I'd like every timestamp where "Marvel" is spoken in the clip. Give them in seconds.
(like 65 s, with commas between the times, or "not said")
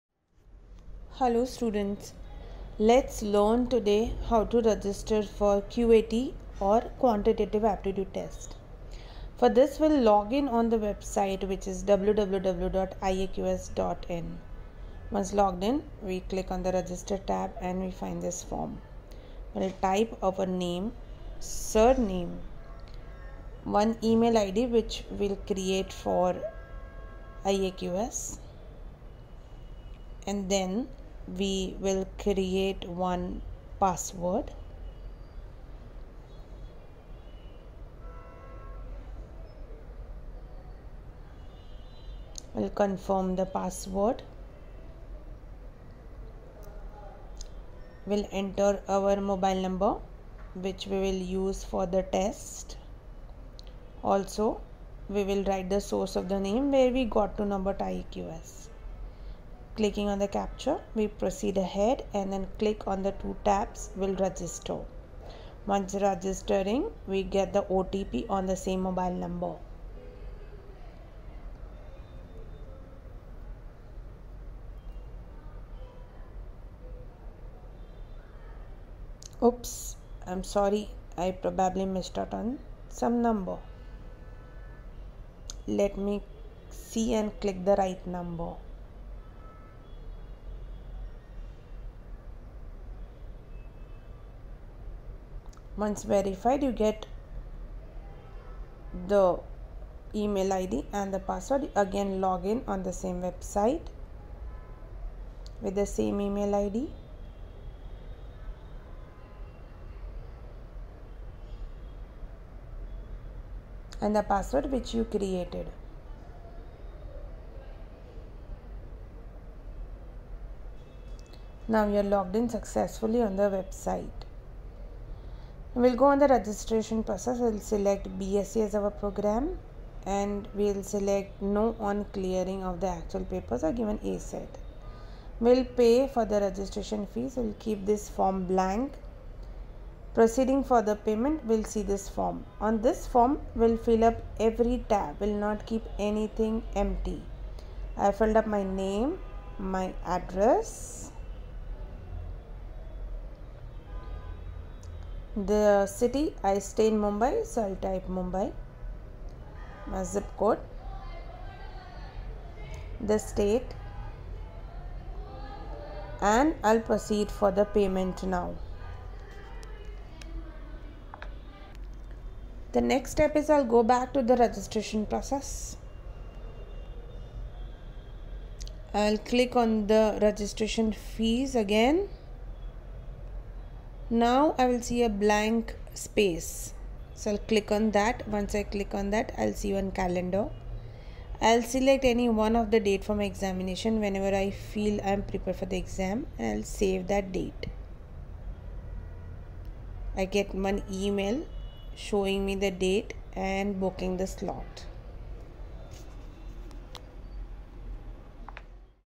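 not said.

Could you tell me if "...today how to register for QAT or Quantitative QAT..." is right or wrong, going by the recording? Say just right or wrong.
wrong.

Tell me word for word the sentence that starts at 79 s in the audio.
Oops, I'm sorry, I probably missed out on some number.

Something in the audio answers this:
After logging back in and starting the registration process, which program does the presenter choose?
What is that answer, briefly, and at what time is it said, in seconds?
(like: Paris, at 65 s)
BSc, at 128 s.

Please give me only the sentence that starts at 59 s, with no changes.
Clicking on the captcha, we proceed ahead and then click on the two tabs will register.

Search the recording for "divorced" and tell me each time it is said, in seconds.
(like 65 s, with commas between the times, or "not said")
not said.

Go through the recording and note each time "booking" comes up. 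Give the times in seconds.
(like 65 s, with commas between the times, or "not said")
203 s.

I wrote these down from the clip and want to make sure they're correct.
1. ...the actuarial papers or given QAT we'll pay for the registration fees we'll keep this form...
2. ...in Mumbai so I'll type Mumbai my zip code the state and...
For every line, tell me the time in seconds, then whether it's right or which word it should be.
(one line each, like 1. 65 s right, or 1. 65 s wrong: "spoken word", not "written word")
1. 132 s wrong: "ACET", not "QAT"
2. 156 s right.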